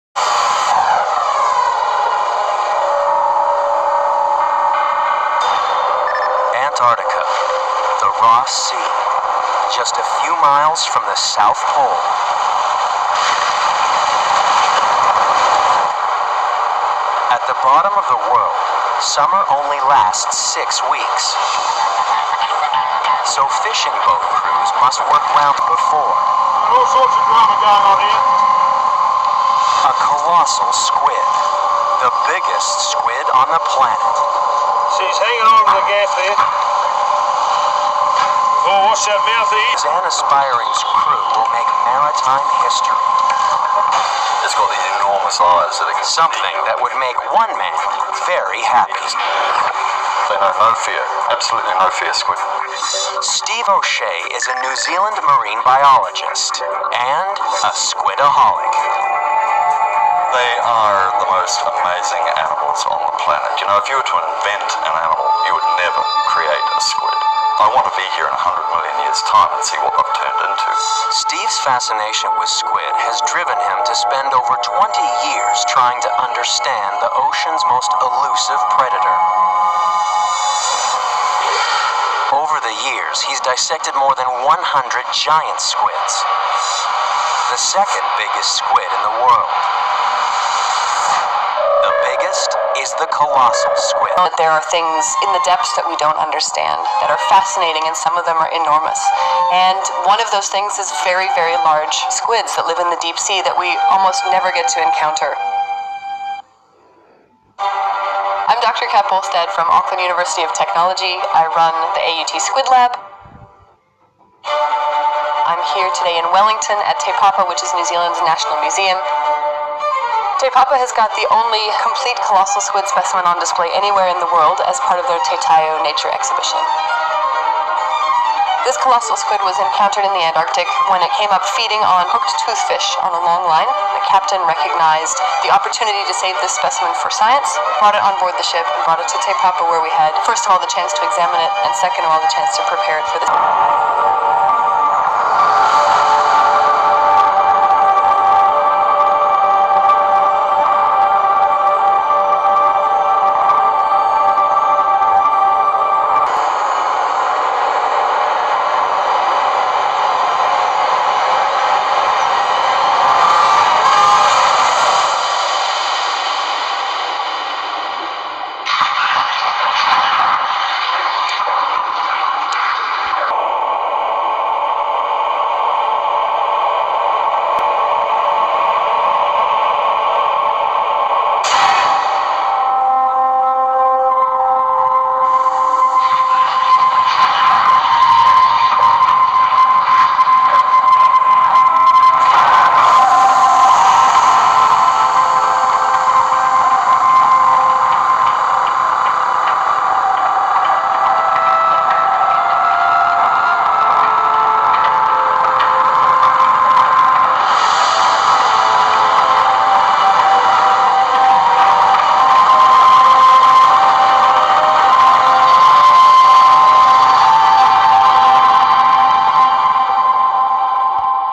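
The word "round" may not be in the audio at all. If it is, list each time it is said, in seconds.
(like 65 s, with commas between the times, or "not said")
25 s.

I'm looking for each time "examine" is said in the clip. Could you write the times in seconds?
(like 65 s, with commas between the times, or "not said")
141 s.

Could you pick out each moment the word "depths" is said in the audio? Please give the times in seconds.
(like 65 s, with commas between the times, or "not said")
95 s.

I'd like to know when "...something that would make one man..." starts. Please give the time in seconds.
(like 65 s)
46 s.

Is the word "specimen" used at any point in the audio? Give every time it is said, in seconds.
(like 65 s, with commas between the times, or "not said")
122 s, 136 s.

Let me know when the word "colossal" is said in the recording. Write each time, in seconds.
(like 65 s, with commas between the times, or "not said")
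30 s, 93 s, 122 s, 128 s.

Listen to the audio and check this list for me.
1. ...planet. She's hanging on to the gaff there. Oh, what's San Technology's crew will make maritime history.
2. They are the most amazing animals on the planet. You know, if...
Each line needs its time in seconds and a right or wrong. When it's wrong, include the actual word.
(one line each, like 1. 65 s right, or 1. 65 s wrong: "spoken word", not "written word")
1. 33 s wrong: "Aspiring", not "Technology"
2. 60 s right.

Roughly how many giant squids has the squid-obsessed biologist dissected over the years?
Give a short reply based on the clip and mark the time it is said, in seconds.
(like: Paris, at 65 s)
More than 100, at 83 s.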